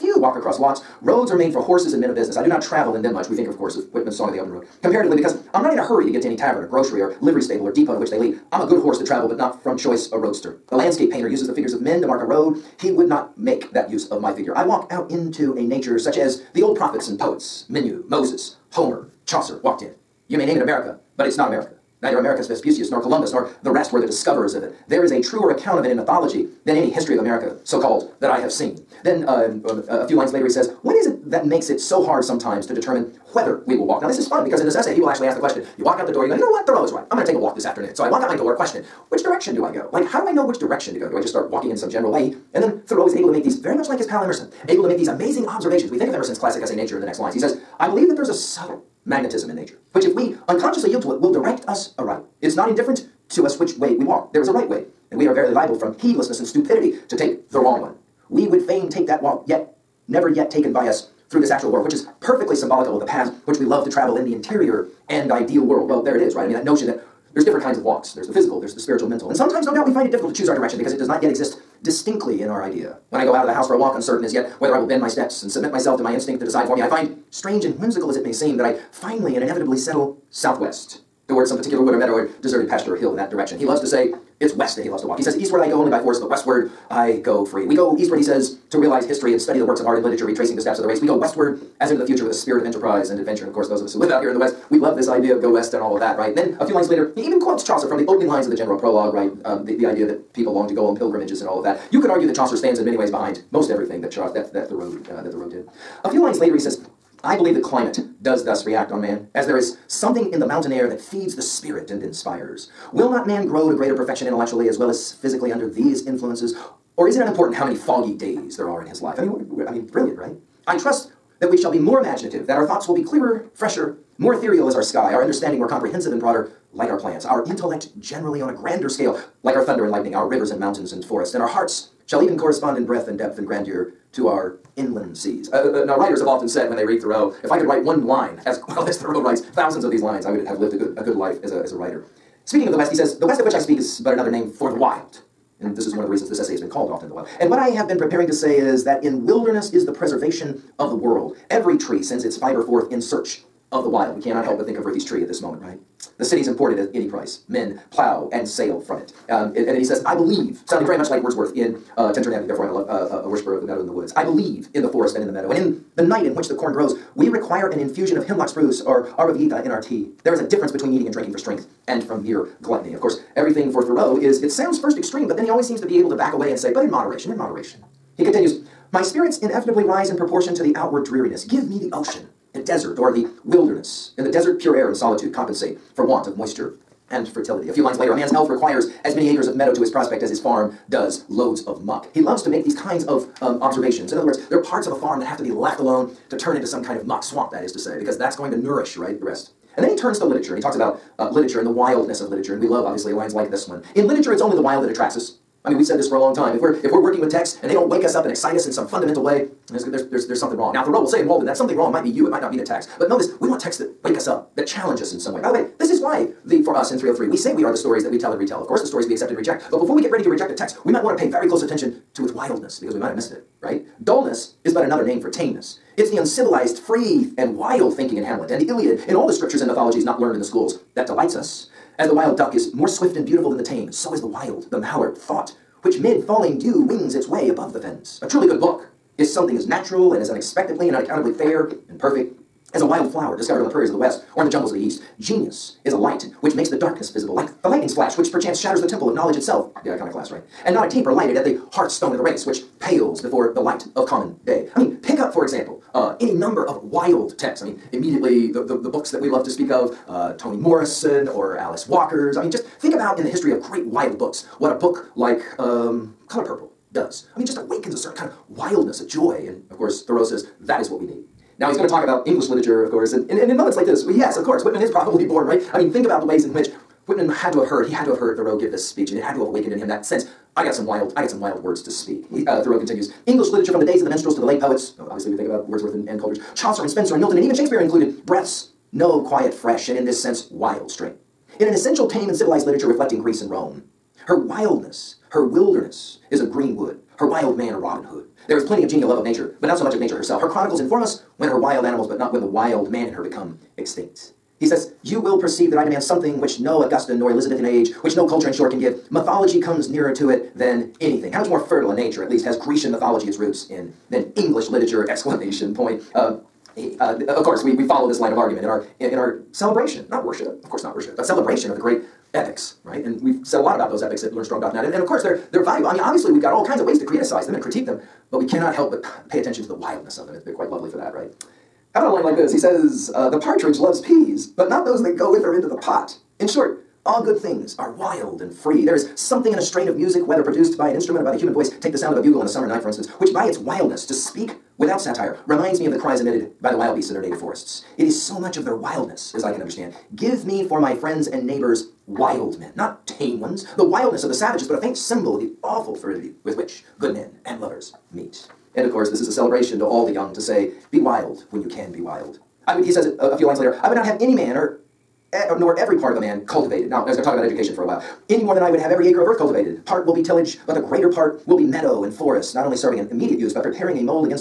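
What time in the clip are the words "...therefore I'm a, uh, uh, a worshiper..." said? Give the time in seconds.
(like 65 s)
162 s.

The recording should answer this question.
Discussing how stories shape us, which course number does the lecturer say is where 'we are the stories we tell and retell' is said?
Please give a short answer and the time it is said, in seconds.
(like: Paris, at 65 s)
303, at 216 s.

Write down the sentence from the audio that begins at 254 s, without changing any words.
I mean, pick up, for example, uh, any number of wild texts.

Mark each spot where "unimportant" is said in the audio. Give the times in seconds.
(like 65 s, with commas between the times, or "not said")
117 s.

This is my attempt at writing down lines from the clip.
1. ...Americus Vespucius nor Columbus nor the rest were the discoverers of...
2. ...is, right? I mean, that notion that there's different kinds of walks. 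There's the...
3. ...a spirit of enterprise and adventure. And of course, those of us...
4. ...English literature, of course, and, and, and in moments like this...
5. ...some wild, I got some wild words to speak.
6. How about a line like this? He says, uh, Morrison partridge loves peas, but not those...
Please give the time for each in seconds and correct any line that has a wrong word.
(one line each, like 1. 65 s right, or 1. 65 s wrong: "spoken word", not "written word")
1. 22 s right
2. 66 s right
3. 92 s right
4. 272 s right
5. 280 s right
6. 331 s wrong: "The", not "Morrison".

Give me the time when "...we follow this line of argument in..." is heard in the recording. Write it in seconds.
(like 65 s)
317 s.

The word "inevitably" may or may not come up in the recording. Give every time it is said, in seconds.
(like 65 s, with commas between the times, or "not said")
79 s, 179 s.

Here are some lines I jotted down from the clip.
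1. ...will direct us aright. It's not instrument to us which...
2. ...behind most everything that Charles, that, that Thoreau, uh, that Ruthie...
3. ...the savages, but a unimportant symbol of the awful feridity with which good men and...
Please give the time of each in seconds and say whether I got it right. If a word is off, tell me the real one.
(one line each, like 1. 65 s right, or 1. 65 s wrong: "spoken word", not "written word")
1. 51 s wrong: "indifferent", not "instrument"
2. 103 s wrong: "Thoreau", not "Ruthie"
3. 354 s wrong: "faint", not "unimportant".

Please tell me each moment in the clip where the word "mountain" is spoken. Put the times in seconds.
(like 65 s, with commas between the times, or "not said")
110 s, 130 s.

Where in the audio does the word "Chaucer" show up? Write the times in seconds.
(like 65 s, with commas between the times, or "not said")
19 s, 97 s, 102 s, 286 s.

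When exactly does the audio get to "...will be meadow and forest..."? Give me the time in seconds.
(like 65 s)
371 s.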